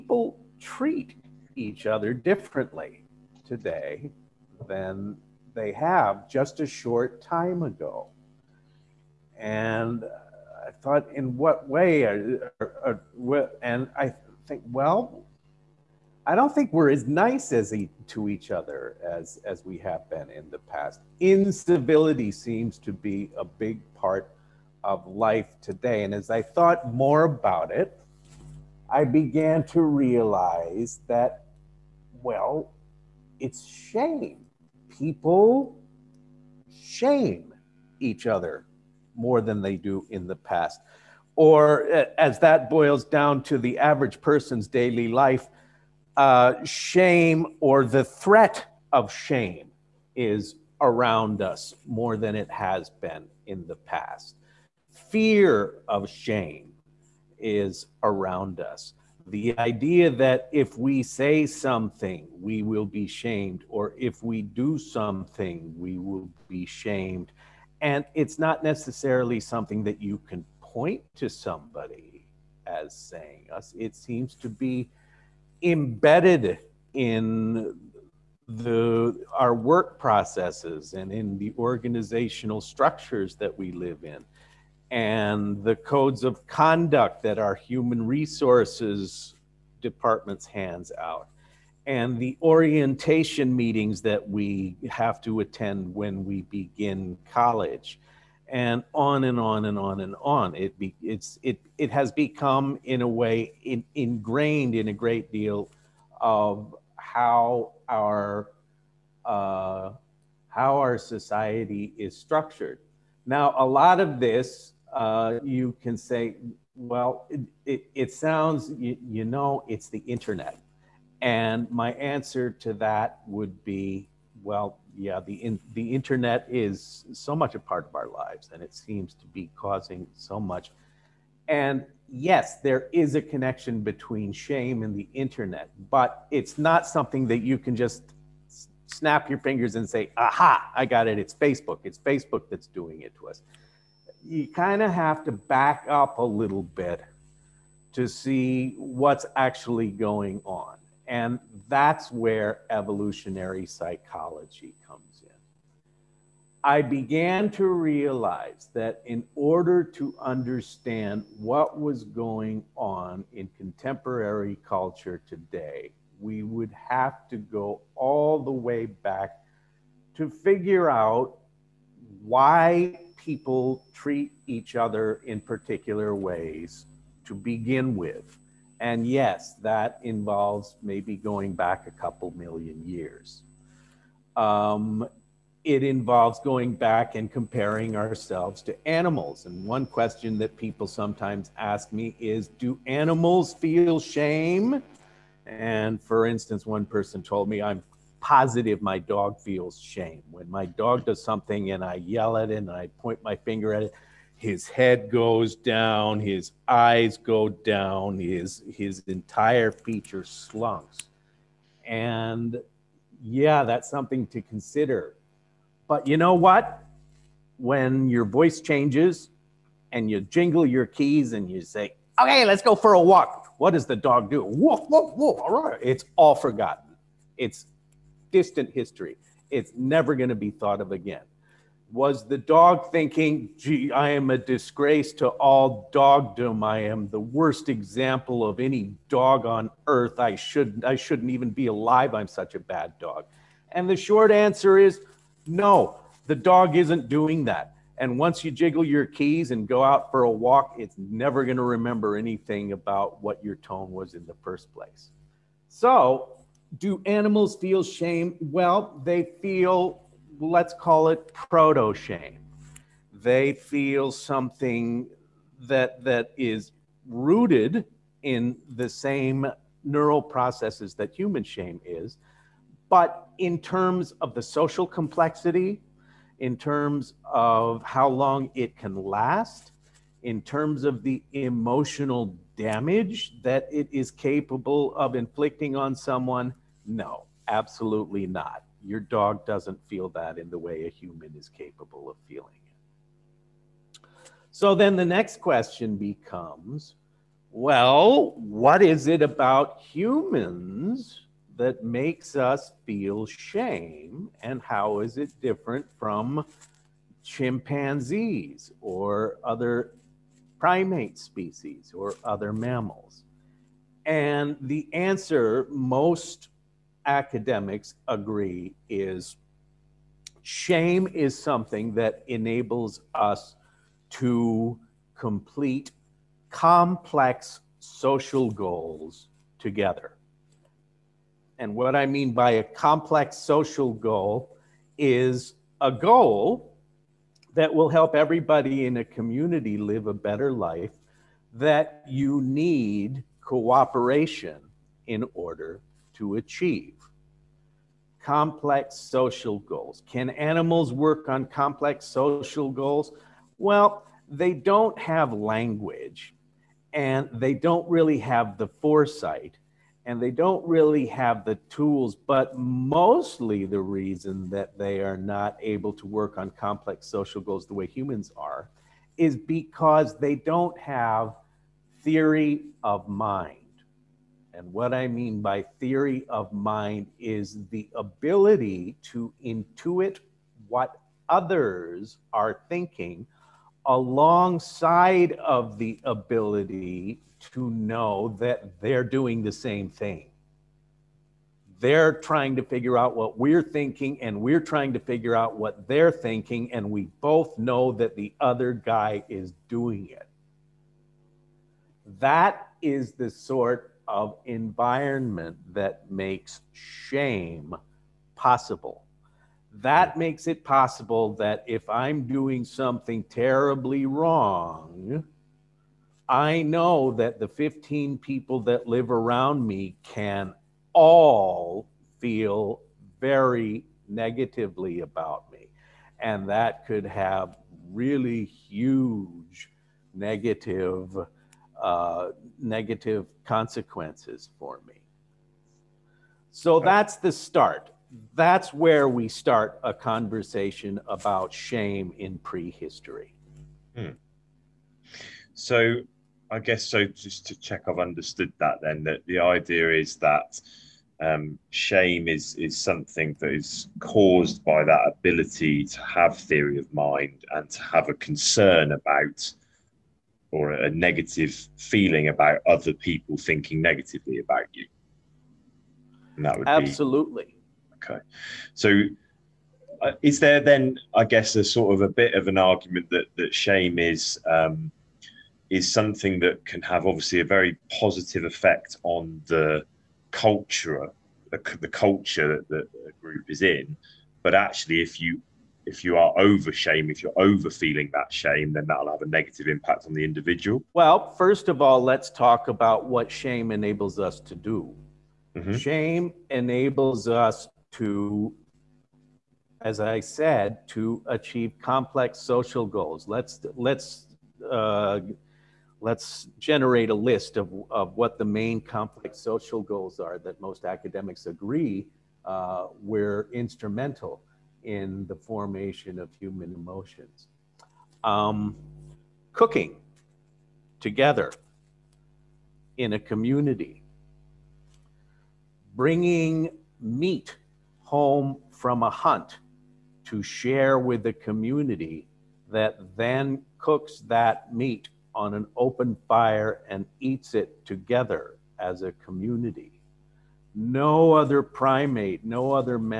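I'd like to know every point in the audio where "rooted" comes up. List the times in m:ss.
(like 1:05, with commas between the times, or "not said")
4:27.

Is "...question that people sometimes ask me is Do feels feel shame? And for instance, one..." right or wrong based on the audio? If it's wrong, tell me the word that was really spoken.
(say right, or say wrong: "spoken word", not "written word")
wrong: "animals", not "feels".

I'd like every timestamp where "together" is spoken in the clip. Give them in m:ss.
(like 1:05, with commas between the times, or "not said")
5:29, 8:41, 8:57.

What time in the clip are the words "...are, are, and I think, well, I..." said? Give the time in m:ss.
0:12.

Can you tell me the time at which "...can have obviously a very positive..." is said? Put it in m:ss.
7:56.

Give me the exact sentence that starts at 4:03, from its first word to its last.
And the short answer is no, the dog isn't doing that.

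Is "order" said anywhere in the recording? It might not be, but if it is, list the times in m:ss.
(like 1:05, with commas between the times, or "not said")
2:39, 5:45.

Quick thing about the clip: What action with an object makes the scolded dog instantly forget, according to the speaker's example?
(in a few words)
Jingle your keys.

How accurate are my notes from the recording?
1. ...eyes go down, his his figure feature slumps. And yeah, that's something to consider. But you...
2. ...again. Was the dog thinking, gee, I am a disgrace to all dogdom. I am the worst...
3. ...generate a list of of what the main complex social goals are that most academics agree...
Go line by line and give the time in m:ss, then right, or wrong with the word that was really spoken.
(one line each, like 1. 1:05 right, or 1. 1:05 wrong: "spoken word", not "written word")
1. 3:26 wrong: "entire", not "figure"
2. 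3:50 right
3. 8:26 right.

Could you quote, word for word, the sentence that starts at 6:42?
That is the sort of environment that makes shame possible.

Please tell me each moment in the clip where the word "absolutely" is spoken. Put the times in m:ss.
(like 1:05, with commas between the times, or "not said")
4:47, 7:46.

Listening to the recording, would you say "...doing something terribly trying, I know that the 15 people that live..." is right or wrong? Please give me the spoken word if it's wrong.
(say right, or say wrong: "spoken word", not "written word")
wrong: "wrong", not "trying".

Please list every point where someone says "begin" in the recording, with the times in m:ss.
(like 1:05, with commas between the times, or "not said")
1:36, 2:57.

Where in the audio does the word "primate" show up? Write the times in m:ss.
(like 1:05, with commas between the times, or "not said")
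5:10, 9:01.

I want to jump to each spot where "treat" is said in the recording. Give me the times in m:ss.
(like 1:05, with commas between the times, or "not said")
0:00, 2:53.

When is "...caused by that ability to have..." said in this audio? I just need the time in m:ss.
7:33.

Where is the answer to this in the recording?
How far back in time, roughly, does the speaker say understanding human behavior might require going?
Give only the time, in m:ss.
3:01.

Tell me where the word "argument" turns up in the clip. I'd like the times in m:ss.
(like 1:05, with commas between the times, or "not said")
7:52.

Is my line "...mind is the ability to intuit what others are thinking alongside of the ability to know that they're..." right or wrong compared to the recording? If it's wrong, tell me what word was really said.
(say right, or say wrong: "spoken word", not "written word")
right.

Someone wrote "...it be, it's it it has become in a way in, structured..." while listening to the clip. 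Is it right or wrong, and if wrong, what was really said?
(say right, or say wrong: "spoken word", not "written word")
wrong: "ingrained", not "structured".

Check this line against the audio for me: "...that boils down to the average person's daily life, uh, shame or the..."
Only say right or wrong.
right.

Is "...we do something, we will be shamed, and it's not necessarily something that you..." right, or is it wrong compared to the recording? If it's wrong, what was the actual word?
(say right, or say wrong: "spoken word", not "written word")
right.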